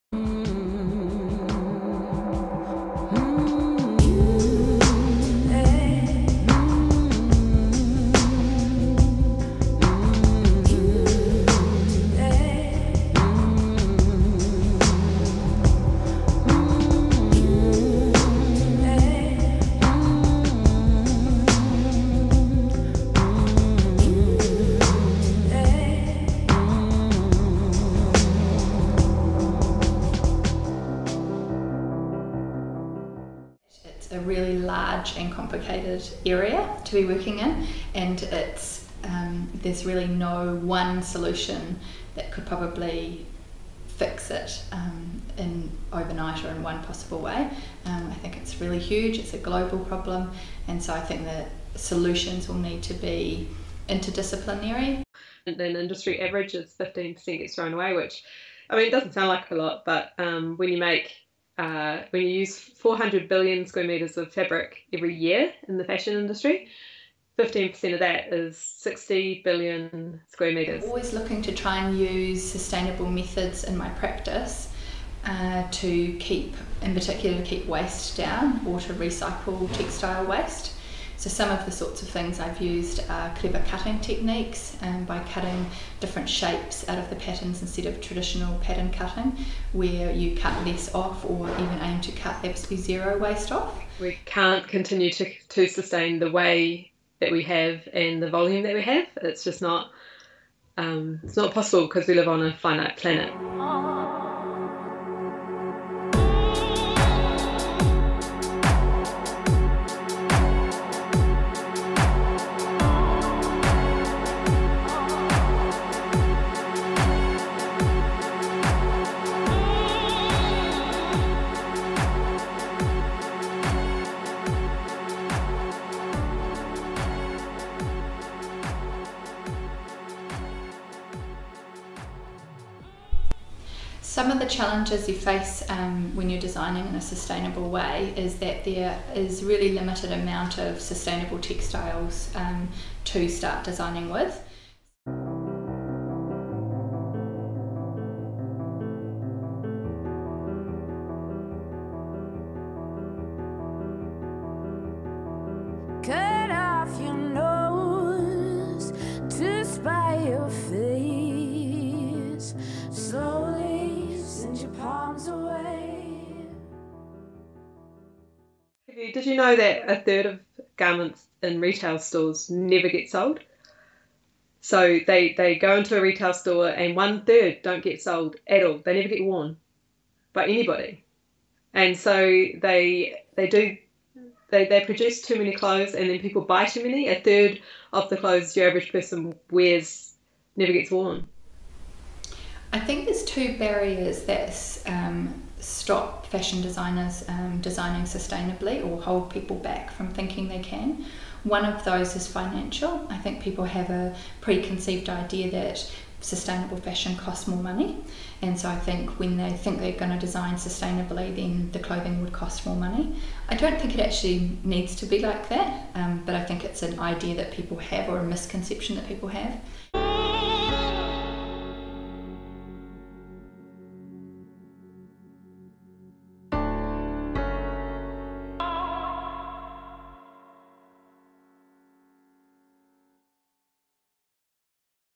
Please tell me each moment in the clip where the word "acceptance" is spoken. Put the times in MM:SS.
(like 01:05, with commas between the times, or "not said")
not said.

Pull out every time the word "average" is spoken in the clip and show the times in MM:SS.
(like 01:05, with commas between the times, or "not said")
00:56, 03:08.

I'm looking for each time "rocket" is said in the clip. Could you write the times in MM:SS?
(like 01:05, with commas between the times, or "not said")
not said.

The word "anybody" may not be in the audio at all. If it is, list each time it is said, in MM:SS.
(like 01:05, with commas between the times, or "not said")
03:00.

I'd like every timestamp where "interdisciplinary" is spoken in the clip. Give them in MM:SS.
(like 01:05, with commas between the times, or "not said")
00:53.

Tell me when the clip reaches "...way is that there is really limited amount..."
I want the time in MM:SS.
02:17.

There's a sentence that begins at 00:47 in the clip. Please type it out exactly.
Um, I think it's really huge.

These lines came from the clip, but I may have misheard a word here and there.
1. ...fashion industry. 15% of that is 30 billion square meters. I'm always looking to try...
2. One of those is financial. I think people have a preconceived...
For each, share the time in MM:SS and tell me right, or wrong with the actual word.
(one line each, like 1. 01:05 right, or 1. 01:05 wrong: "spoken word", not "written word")
1. 01:05 wrong: "60", not "30"
2. 03:21 right.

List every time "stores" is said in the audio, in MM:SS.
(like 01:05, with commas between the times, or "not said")
02:51, 02:56.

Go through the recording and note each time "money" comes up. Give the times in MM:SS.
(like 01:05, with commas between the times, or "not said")
03:27, 03:32.